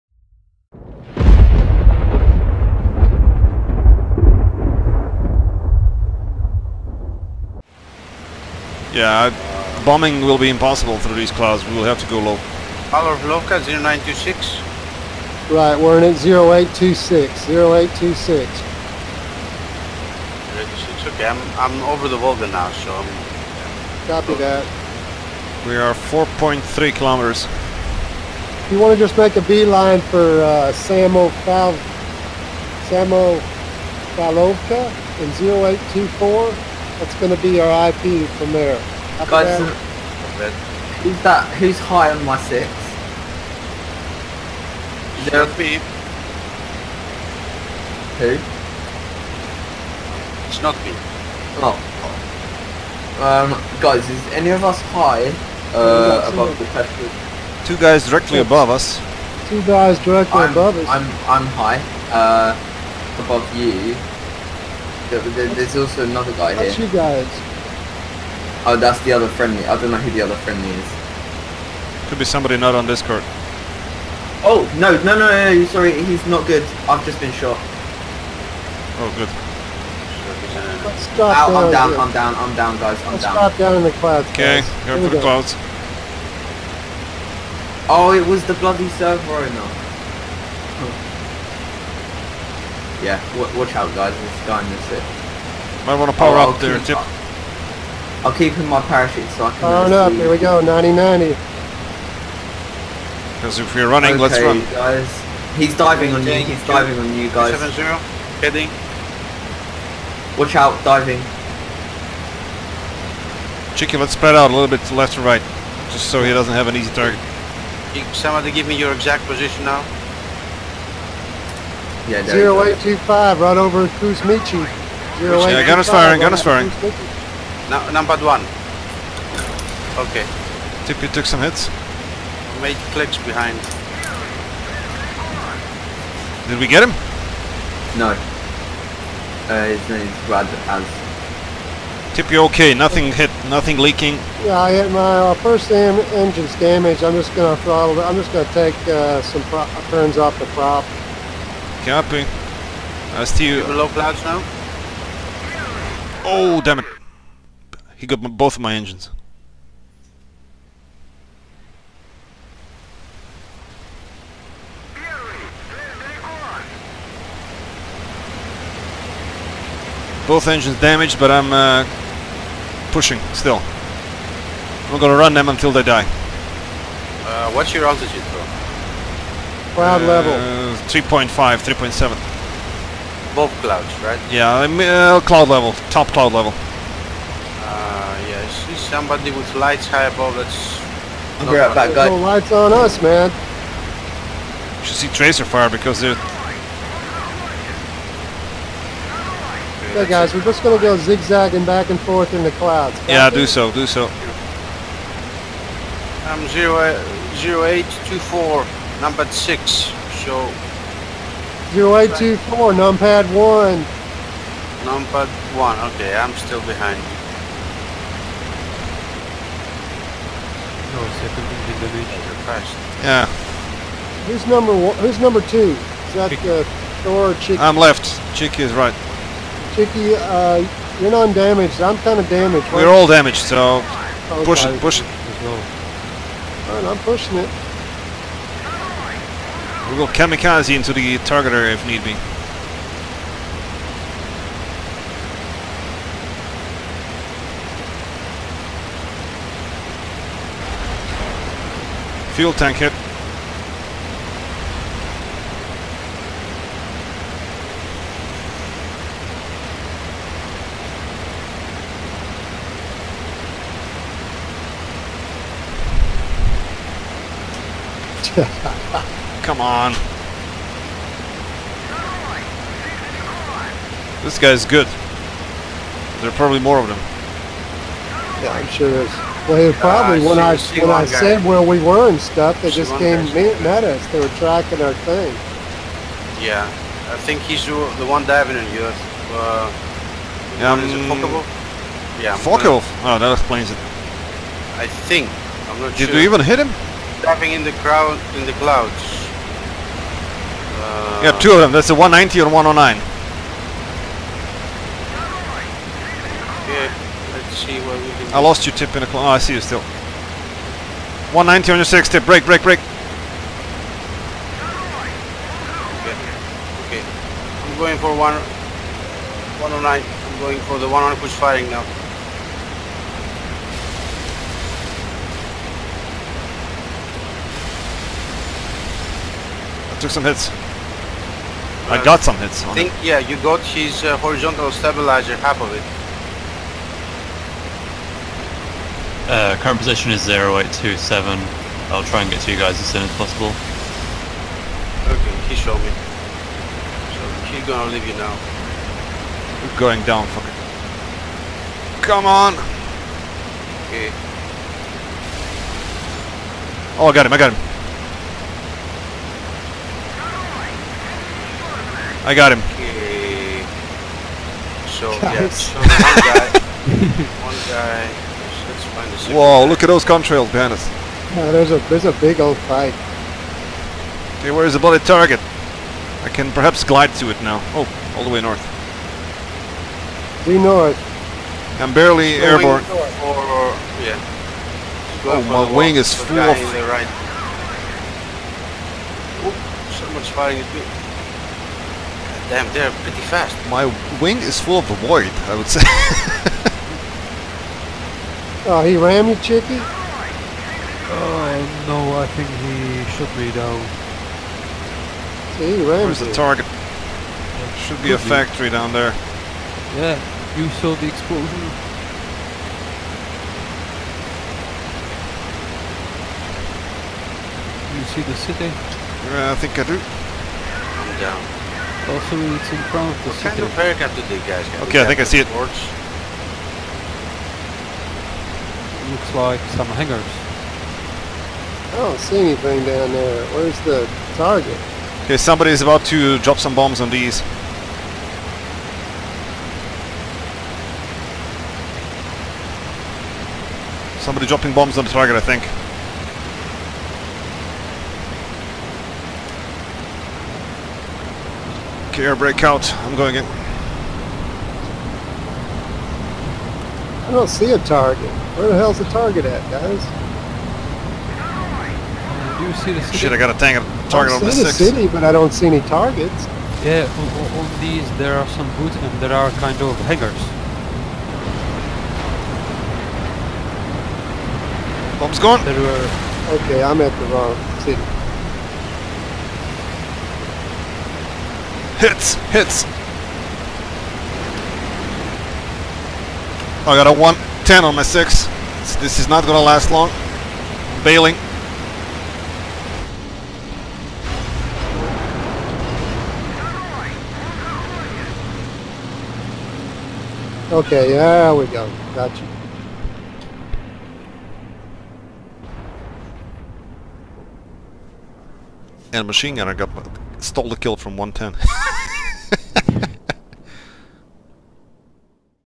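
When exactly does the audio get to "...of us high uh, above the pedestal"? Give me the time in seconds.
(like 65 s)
54 s.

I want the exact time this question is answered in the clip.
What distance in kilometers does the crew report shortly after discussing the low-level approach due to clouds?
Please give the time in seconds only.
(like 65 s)
25 s.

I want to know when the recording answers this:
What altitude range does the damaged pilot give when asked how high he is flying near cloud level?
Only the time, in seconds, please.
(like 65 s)
180 s.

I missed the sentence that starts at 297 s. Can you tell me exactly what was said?
Diving in the crowd in the clouds.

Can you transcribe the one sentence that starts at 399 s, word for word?
Oh, uh, no, I think he shot me down.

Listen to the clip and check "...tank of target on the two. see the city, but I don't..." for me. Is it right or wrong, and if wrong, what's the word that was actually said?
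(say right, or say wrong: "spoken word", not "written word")
wrong: "six", not "two".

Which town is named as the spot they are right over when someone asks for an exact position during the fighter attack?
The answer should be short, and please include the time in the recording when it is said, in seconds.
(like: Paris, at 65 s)
Kuzmichi, at 124 s.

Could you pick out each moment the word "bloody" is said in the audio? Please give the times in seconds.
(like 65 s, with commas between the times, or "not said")
88 s, 374 s.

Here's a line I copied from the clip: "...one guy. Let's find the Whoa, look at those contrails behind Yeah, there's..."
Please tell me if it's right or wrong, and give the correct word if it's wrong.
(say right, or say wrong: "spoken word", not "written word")
right.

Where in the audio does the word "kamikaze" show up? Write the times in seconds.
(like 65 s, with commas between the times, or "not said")
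240 s.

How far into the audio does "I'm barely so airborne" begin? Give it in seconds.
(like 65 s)
381 s.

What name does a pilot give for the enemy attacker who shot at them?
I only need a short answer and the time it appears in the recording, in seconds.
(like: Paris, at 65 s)
Brad, at 140 s.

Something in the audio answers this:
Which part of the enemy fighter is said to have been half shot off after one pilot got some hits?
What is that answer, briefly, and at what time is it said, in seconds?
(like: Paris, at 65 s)
Horizontal stabilizer, at 334 s.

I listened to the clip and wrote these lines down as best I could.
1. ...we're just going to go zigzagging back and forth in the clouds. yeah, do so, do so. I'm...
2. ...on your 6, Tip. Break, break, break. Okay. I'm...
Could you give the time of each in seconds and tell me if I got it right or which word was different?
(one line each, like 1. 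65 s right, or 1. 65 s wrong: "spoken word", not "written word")
1. 200 s right
2. 311 s right.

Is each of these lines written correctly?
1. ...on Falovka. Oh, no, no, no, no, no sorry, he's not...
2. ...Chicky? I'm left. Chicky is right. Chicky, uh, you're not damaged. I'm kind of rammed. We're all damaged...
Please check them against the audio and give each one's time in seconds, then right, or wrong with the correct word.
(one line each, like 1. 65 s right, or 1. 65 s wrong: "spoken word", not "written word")
1. 72 s wrong: "Discord", not "Falovka"
2. 227 s wrong: "damaged", not "rammed".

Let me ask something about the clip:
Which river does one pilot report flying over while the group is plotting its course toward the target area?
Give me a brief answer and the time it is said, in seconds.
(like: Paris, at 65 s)
Volga, at 22 s.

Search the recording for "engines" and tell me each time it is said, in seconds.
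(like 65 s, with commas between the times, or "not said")
145 s, 158 s, 170 s.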